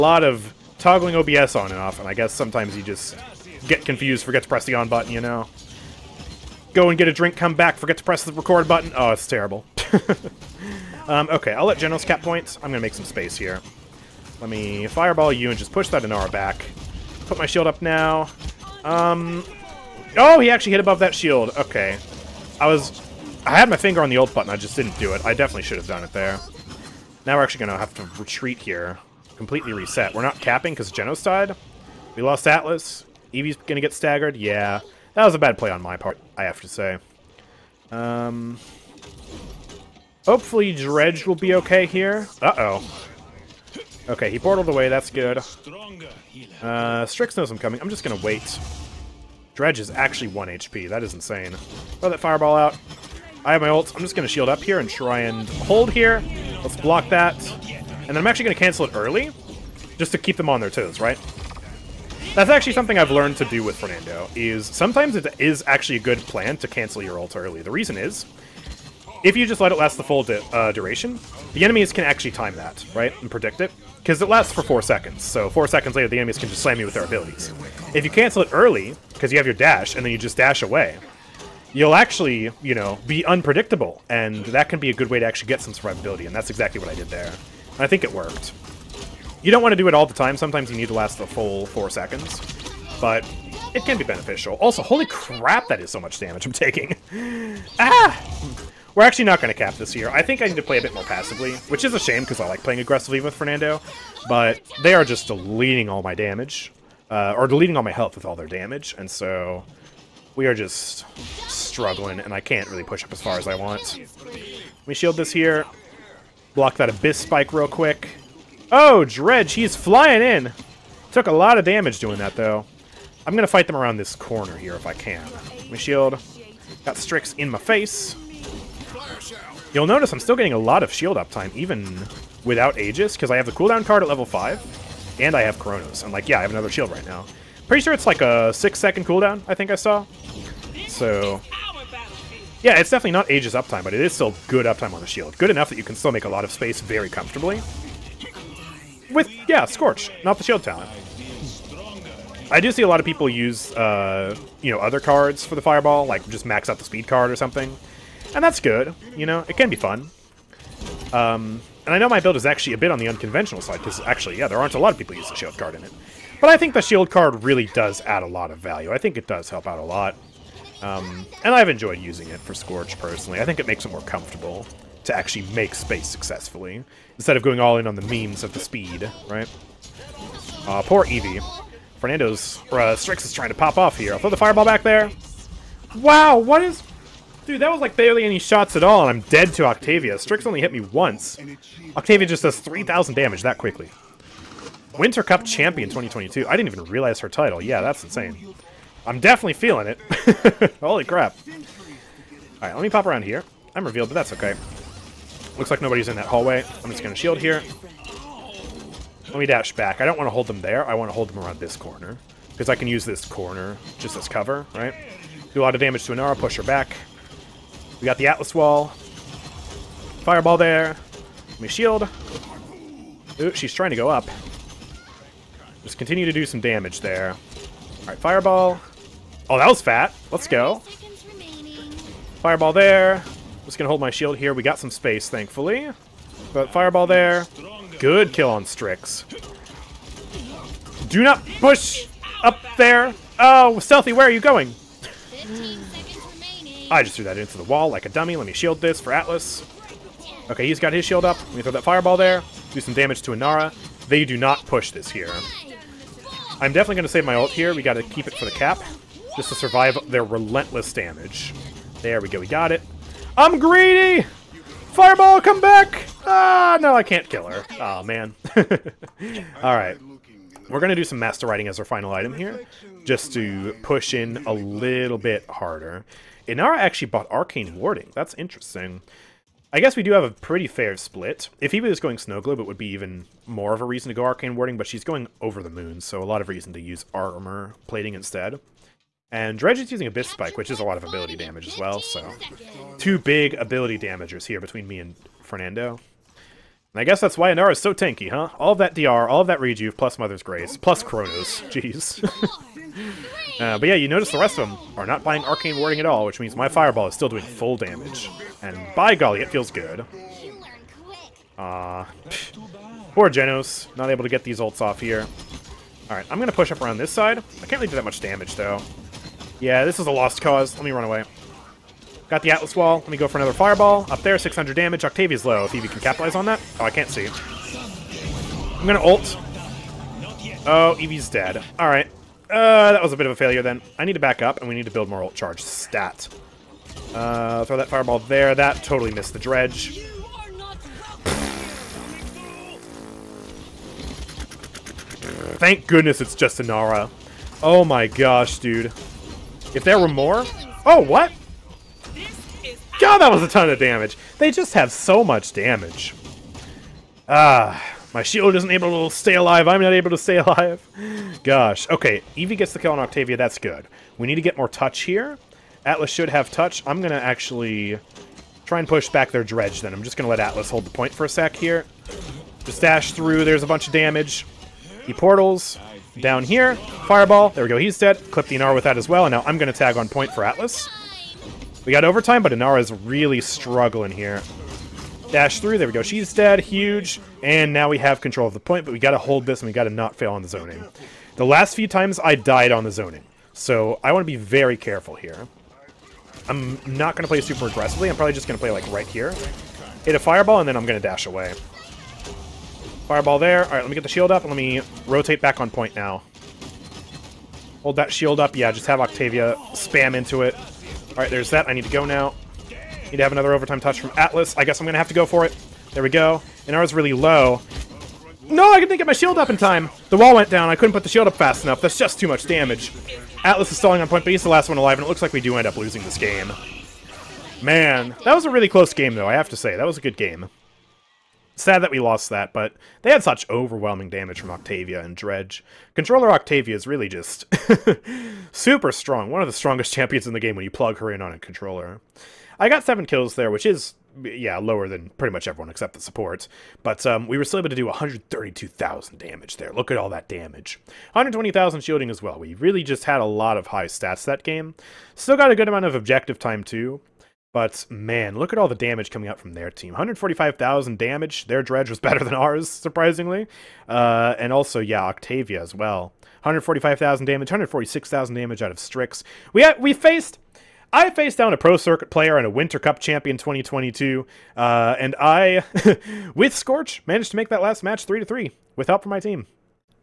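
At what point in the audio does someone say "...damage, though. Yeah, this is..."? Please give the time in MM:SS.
05:18.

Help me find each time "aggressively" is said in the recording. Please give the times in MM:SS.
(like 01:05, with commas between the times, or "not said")
01:42, 06:37.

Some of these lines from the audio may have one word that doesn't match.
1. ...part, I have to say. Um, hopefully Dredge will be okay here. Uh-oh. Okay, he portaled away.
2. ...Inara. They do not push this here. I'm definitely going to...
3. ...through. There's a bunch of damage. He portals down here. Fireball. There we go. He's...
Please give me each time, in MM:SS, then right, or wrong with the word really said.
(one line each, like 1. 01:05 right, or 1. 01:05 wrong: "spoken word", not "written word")
1. 00:35 right
2. 04:13 right
3. 06:13 right.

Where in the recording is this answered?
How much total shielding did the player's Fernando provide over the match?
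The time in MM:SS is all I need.
07:31.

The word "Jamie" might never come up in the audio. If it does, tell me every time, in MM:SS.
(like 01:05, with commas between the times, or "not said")
not said.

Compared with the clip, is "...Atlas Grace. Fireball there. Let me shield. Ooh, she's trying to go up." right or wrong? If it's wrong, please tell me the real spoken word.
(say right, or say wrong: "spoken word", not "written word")
wrong: "Wall", not "Grace".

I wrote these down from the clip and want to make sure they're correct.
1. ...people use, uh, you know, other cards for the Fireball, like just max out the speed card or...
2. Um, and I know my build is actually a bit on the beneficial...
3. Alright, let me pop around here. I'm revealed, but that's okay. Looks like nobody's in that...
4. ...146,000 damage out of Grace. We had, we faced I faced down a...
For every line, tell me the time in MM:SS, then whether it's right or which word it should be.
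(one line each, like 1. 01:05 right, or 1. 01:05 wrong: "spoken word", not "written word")
1. 02:33 right
2. 02:41 wrong: "unconventional", not "beneficial"
3. 03:22 right
4. 07:47 wrong: "Strix", not "Grace".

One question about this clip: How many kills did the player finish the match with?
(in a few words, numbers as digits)
7.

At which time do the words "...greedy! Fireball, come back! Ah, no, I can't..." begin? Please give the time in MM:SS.
04:23.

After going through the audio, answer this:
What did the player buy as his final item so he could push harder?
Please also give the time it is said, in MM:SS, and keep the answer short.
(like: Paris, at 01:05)
Master Riding, at 04:31.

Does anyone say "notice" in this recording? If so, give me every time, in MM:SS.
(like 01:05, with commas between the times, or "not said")
02:09, 05:04.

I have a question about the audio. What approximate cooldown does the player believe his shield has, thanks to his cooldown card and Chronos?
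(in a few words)
6 seconds.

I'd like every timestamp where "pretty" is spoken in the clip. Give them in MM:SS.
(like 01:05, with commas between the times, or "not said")
02:17, 04:40, 07:25.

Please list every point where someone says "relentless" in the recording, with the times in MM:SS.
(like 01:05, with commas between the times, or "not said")
04:20.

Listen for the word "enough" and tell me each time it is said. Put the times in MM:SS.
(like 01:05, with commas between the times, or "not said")
02:25, 07:01.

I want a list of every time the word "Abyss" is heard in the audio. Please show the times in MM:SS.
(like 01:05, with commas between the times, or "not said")
01:56, 04:50.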